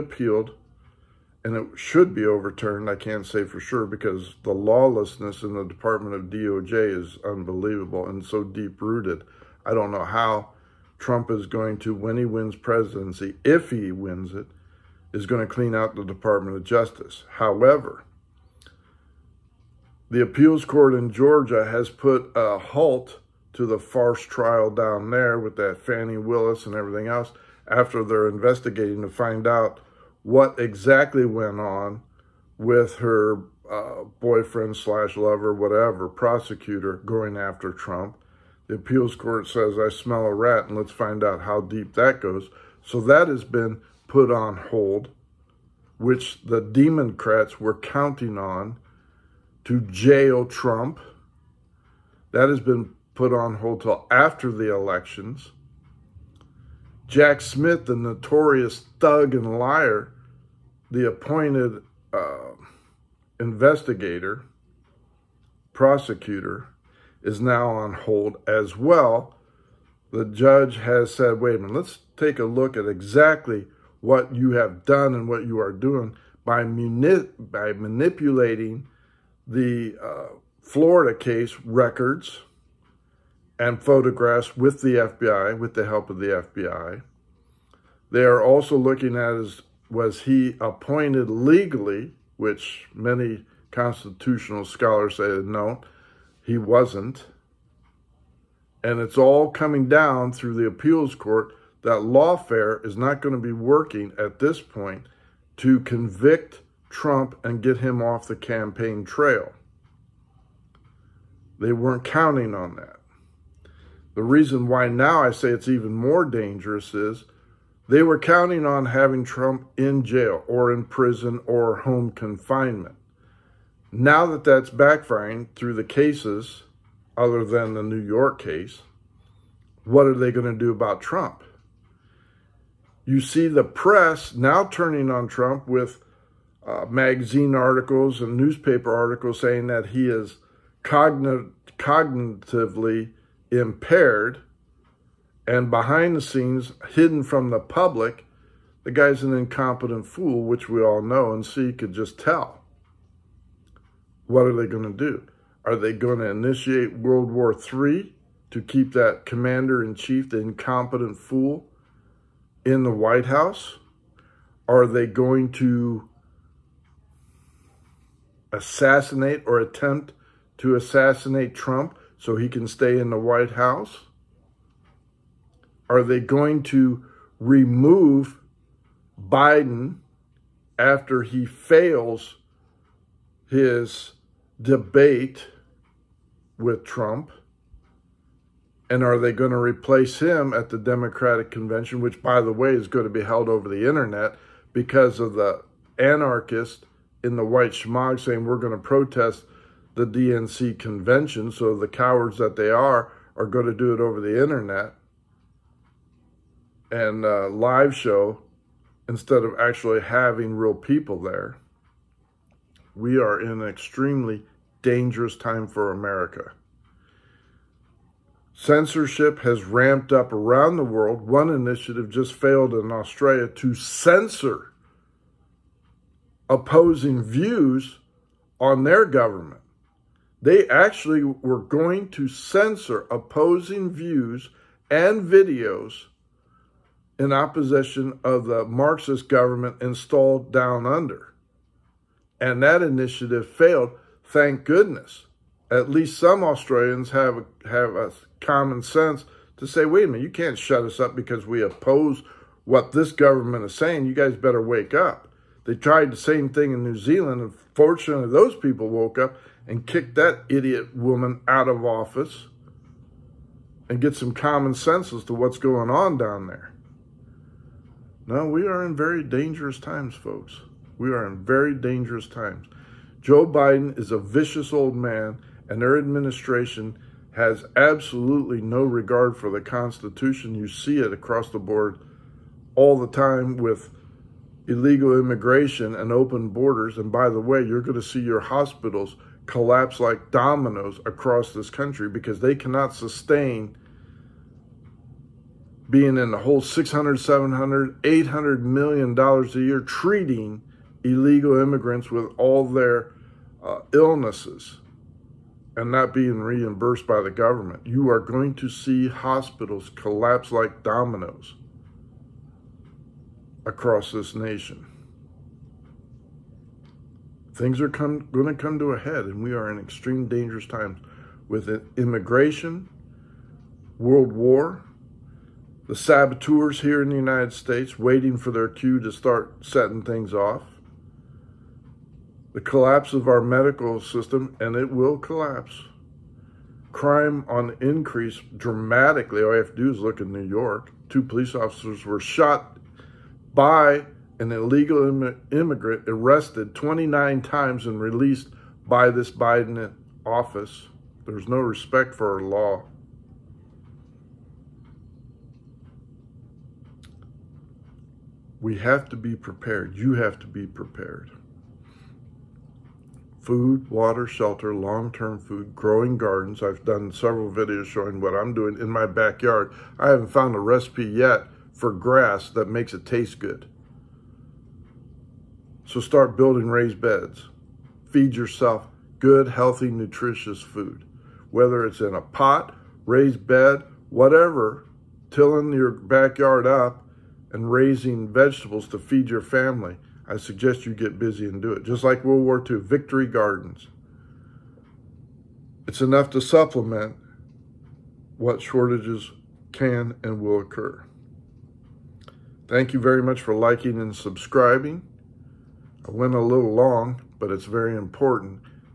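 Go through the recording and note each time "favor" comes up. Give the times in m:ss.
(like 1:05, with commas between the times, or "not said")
not said.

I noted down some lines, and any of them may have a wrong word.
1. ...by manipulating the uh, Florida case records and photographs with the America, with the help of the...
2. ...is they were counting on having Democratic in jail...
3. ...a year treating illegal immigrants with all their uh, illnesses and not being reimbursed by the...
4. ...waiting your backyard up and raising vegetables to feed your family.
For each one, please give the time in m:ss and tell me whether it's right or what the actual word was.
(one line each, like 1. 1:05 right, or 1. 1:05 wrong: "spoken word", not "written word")
1. 1:17 wrong: "FBI", not "America"
2. 1:56 wrong: "Trump", not "Democratic"
3. 4:59 right
4. 6:25 wrong: "tilling", not "waiting".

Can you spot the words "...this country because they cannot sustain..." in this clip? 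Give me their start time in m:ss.
4:51.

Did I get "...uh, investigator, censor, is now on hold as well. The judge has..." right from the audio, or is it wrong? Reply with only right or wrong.
wrong.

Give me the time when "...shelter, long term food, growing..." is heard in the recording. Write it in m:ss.
6:04.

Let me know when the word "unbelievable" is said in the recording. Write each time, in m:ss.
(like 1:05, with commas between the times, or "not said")
0:07.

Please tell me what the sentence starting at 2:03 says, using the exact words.
Now that that's backfiring through the cases, other than the New York case, what are they going to do about Trump?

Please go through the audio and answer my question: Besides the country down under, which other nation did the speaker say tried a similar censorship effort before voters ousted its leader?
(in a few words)
New Zealand.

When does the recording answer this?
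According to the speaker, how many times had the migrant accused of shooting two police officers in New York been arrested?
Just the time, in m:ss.
5:46.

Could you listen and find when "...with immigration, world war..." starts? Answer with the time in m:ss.
5:21.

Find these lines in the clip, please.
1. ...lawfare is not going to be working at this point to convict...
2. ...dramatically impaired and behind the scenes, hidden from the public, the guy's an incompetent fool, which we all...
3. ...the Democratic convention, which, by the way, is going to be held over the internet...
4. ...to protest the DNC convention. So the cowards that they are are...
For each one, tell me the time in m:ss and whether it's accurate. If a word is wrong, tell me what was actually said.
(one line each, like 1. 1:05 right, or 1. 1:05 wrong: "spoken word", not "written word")
1. 1:42 right
2. 2:20 wrong: "cognitively", not "dramatically"
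3. 3:10 right
4. 3:18 right.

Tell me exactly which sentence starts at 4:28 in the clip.
Now, we are in very dangerous times, folks.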